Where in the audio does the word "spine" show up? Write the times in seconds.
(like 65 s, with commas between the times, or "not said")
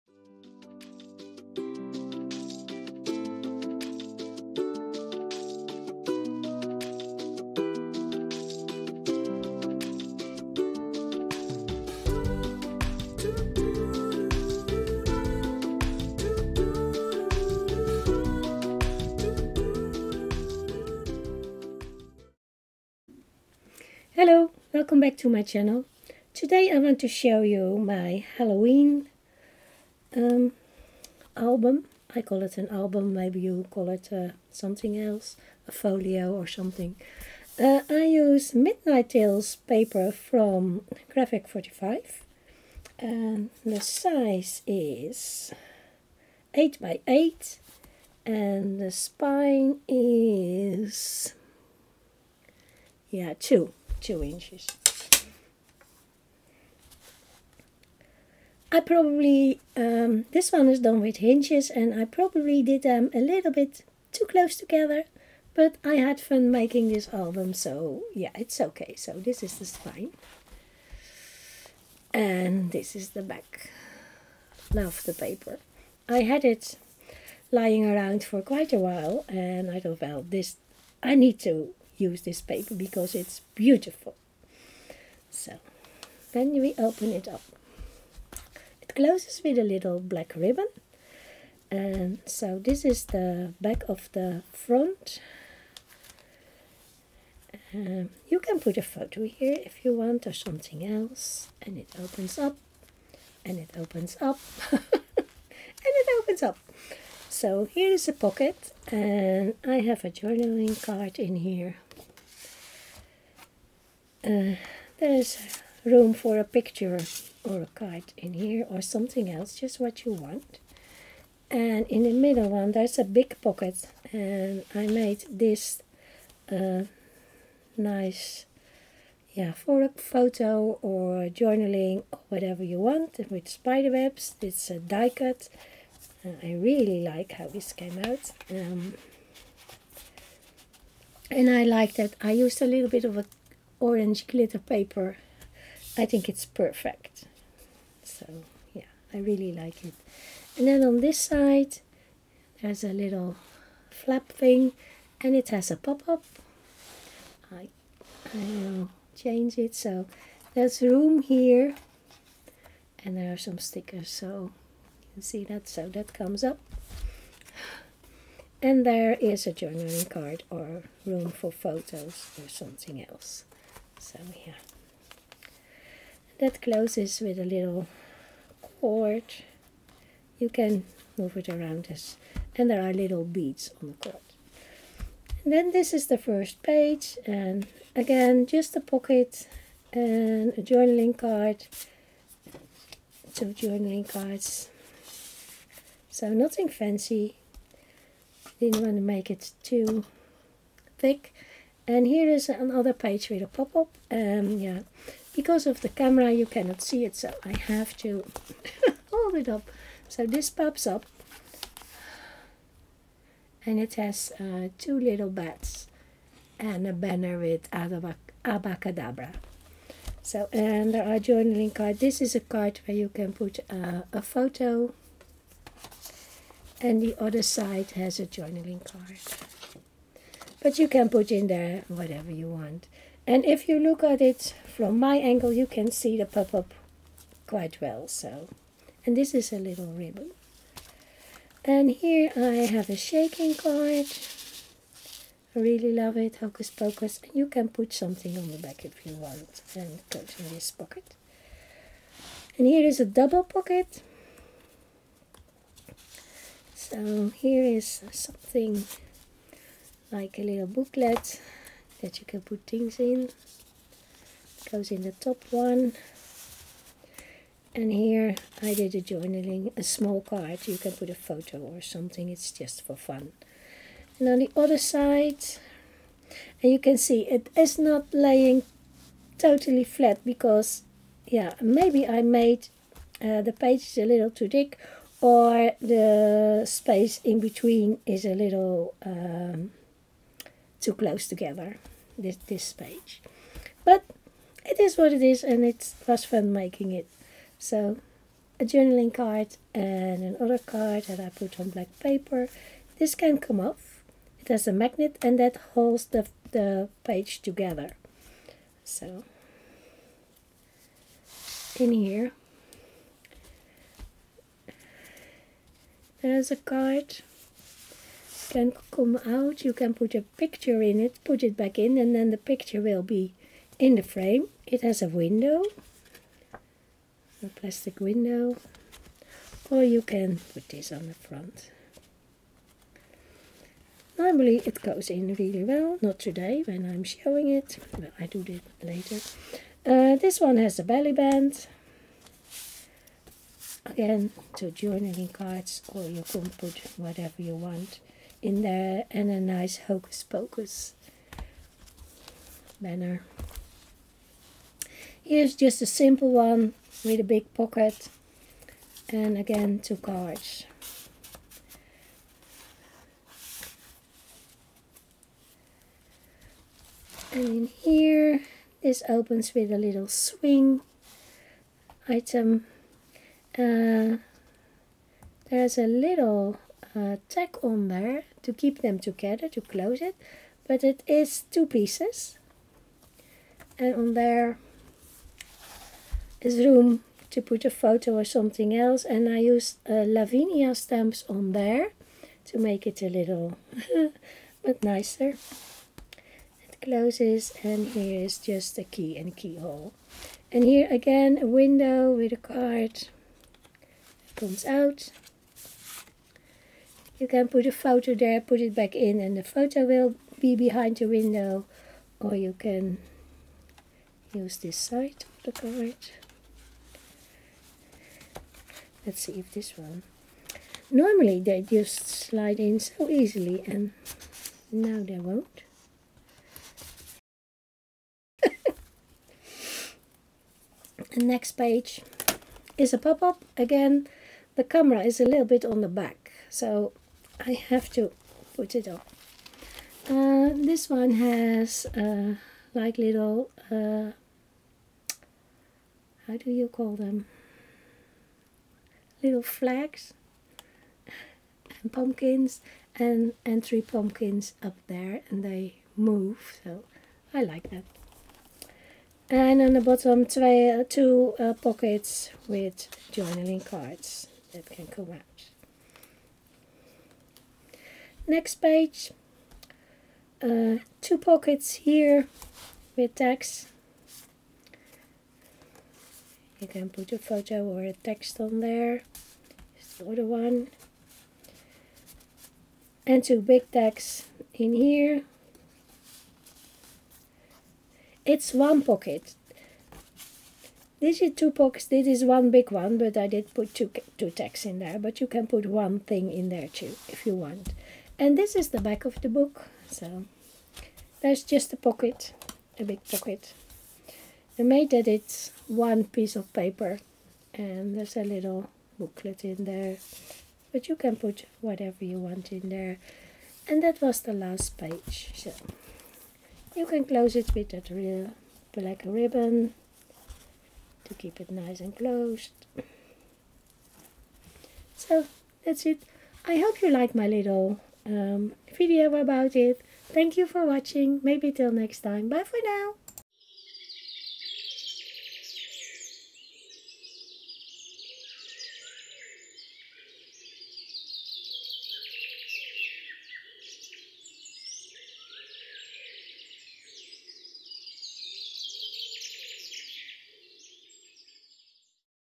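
48 s, 69 s.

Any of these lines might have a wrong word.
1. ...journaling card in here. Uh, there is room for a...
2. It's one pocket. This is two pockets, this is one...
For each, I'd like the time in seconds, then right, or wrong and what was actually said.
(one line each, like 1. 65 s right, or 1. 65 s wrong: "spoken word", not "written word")
1. 110 s right
2. 488 s right.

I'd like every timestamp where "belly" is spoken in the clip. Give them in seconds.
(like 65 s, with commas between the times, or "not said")
340 s.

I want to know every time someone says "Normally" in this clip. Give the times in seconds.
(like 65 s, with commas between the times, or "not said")
334 s, 420 s.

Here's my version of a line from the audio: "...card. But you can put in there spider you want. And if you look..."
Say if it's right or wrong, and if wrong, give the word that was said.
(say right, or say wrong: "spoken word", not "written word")
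wrong: "whatever", not "spider".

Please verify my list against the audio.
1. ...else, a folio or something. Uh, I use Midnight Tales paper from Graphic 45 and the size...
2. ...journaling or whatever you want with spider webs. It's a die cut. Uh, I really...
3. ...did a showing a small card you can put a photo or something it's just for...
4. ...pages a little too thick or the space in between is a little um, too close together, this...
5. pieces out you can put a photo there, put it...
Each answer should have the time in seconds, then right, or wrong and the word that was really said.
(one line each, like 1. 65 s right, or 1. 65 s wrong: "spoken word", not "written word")
1. 34 s right
2. 131 s right
3. 268 s wrong: "journaling", not "showing"
4. 283 s right
5. 404 s wrong: "comes", not "pieces".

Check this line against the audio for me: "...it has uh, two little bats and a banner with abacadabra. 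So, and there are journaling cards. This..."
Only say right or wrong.
right.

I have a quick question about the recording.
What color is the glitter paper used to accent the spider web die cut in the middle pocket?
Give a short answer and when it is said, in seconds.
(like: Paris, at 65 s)
Orange, at 143 s.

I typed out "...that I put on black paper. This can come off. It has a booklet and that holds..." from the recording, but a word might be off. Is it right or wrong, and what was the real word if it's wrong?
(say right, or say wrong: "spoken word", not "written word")
wrong: "magnet", not "booklet".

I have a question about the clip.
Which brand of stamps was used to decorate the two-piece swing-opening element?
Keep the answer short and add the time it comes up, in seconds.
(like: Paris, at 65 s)
Lavinia, at 390 s.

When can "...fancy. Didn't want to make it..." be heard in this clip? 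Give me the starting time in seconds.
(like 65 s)
196 s.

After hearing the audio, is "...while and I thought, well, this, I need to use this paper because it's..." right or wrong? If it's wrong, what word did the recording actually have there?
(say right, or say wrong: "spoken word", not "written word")
right.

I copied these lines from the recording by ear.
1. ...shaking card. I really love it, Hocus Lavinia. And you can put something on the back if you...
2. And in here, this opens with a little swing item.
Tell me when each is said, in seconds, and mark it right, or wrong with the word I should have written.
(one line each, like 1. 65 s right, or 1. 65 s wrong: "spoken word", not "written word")
1. 242 s wrong: "Pocus", not "Lavinia"
2. 367 s right.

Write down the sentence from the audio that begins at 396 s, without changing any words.
It closes and here is just a key and keyhole.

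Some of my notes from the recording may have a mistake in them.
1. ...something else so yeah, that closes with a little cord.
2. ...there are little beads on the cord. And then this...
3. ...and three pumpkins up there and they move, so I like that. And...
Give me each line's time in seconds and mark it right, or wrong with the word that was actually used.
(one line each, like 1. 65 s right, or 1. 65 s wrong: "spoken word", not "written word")
1. 172 s right
2. 182 s right
3. 453 s right.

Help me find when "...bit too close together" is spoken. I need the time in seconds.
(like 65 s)
63 s.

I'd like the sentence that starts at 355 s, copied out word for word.
Here's just a simple one with a big pocket and again two cards.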